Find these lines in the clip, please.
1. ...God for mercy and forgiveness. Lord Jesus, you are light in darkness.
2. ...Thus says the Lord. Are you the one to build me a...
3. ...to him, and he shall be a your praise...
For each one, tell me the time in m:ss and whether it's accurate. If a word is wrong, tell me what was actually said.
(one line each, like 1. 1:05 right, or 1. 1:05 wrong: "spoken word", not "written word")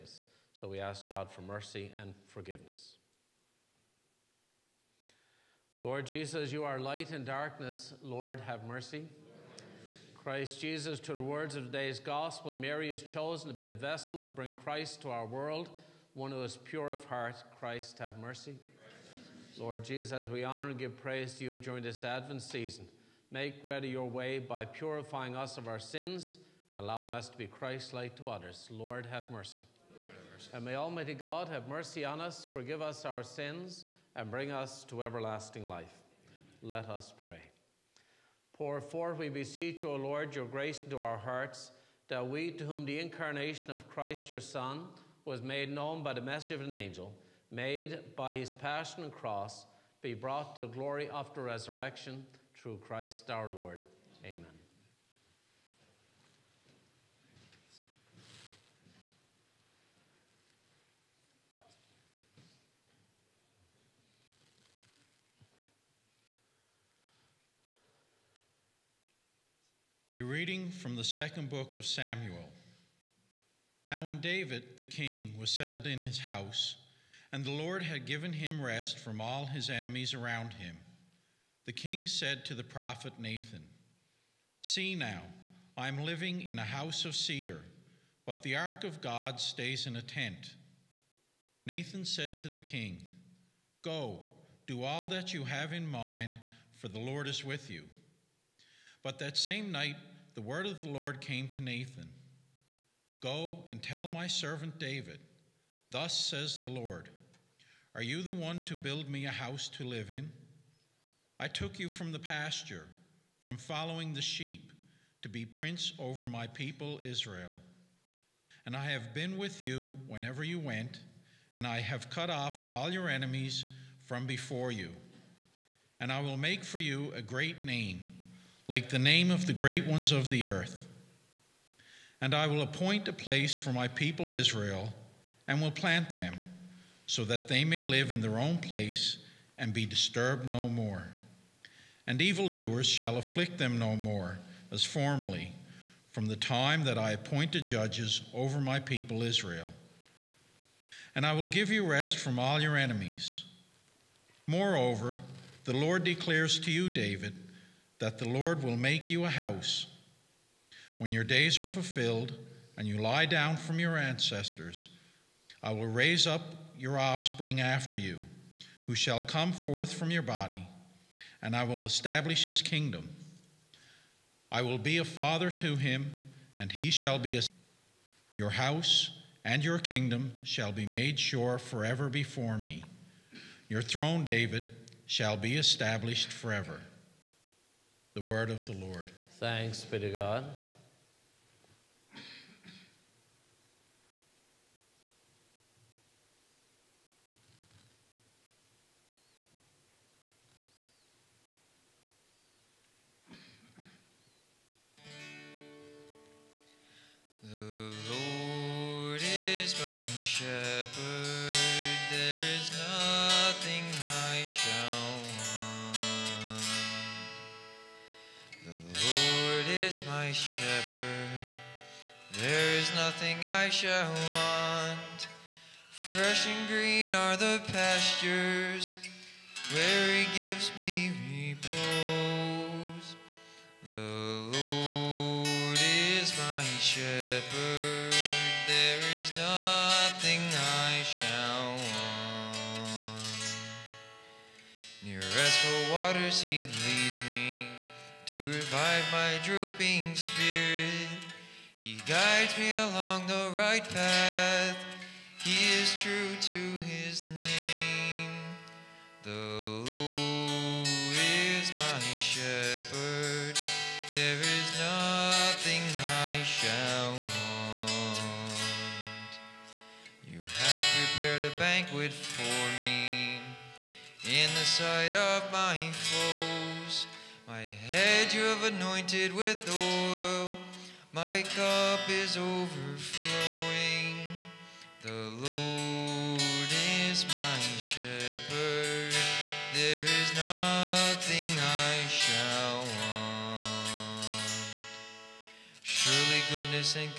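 1. 0:01 right
2. 1:45 right
3. 2:55 wrong: "house", not "praise".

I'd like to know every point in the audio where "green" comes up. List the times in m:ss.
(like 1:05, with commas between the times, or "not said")
3:46.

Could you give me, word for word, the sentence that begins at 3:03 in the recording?
Your throne, David, shall be established forever.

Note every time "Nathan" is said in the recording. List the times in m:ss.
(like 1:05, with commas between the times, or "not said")
1:23, 1:31, 1:41.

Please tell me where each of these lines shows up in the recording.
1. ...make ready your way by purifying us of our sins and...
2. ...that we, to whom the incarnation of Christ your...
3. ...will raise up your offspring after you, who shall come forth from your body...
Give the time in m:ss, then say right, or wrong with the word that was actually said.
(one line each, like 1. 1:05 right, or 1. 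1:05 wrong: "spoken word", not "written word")
1. 0:23 right
2. 0:42 right
3. 2:45 right.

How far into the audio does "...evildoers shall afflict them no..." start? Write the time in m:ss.
2:22.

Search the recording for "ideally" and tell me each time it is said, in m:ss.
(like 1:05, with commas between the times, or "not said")
not said.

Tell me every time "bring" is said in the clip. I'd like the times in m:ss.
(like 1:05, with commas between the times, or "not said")
0:14, 0:34.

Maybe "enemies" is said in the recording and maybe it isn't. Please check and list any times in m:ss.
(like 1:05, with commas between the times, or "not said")
1:19, 2:03, 2:32.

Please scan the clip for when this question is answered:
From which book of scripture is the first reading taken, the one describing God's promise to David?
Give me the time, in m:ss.
1:11.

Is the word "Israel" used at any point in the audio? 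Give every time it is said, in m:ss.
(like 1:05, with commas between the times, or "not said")
1:57, 2:14, 2:29.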